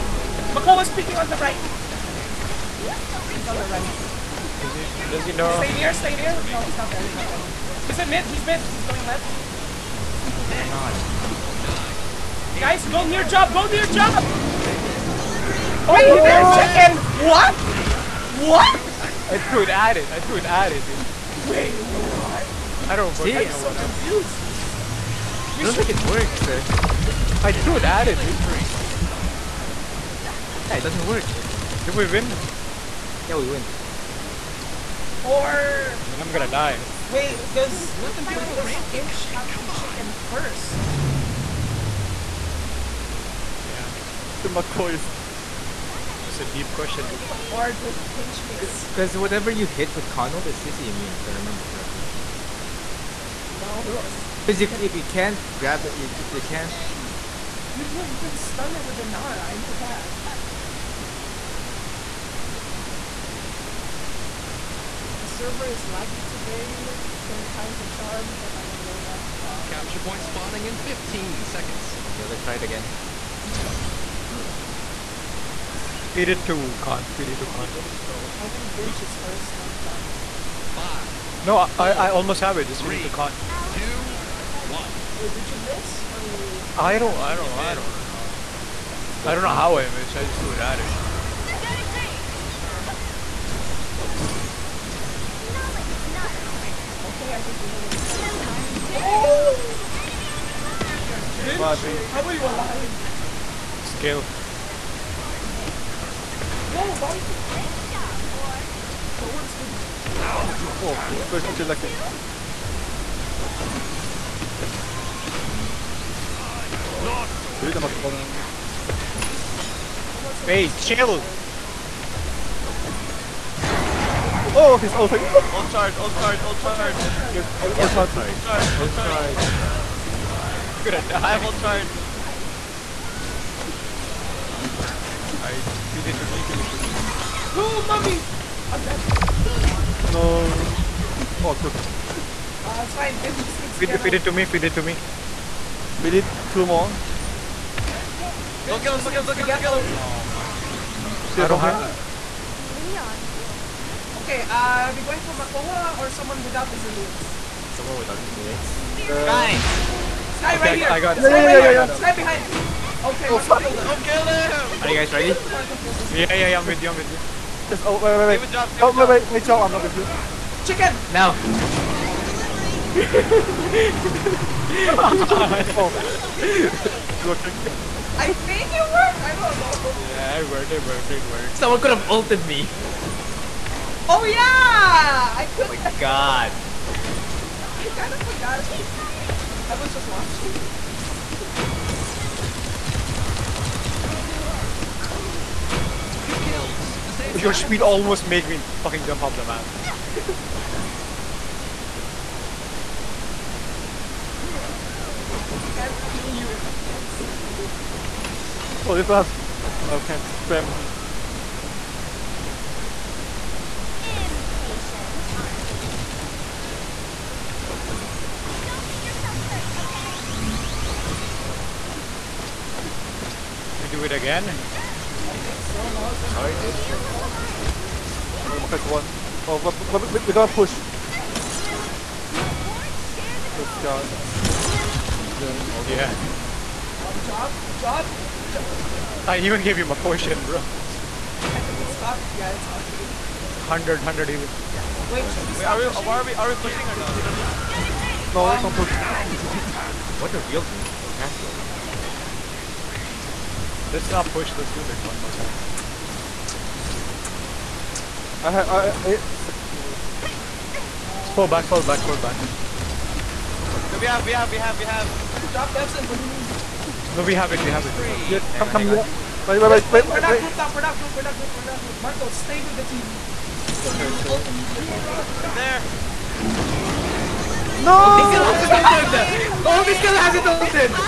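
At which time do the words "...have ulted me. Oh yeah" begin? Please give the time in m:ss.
3:01.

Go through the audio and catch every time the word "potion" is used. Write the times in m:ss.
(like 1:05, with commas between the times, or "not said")
3:59.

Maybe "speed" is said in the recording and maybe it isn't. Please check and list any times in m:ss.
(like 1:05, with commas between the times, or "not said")
3:17.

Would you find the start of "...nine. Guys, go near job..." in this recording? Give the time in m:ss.
0:12.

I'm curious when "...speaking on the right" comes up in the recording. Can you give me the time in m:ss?
0:00.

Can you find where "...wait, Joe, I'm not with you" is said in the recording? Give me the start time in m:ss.
2:49.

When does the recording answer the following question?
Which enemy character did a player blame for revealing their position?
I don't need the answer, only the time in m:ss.
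4:11.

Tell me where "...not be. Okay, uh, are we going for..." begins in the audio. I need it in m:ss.
2:33.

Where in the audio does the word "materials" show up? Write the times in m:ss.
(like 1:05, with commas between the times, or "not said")
not said.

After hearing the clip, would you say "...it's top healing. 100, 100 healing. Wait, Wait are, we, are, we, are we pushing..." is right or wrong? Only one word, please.
right.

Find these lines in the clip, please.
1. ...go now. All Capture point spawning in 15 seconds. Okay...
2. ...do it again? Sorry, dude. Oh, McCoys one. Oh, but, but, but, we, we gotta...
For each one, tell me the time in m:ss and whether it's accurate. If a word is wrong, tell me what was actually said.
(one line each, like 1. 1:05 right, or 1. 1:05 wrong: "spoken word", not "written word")
1. 1:08 right
2. 3:43 wrong: "Makai", not "McCoys".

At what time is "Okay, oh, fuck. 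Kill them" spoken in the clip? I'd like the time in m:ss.
2:43.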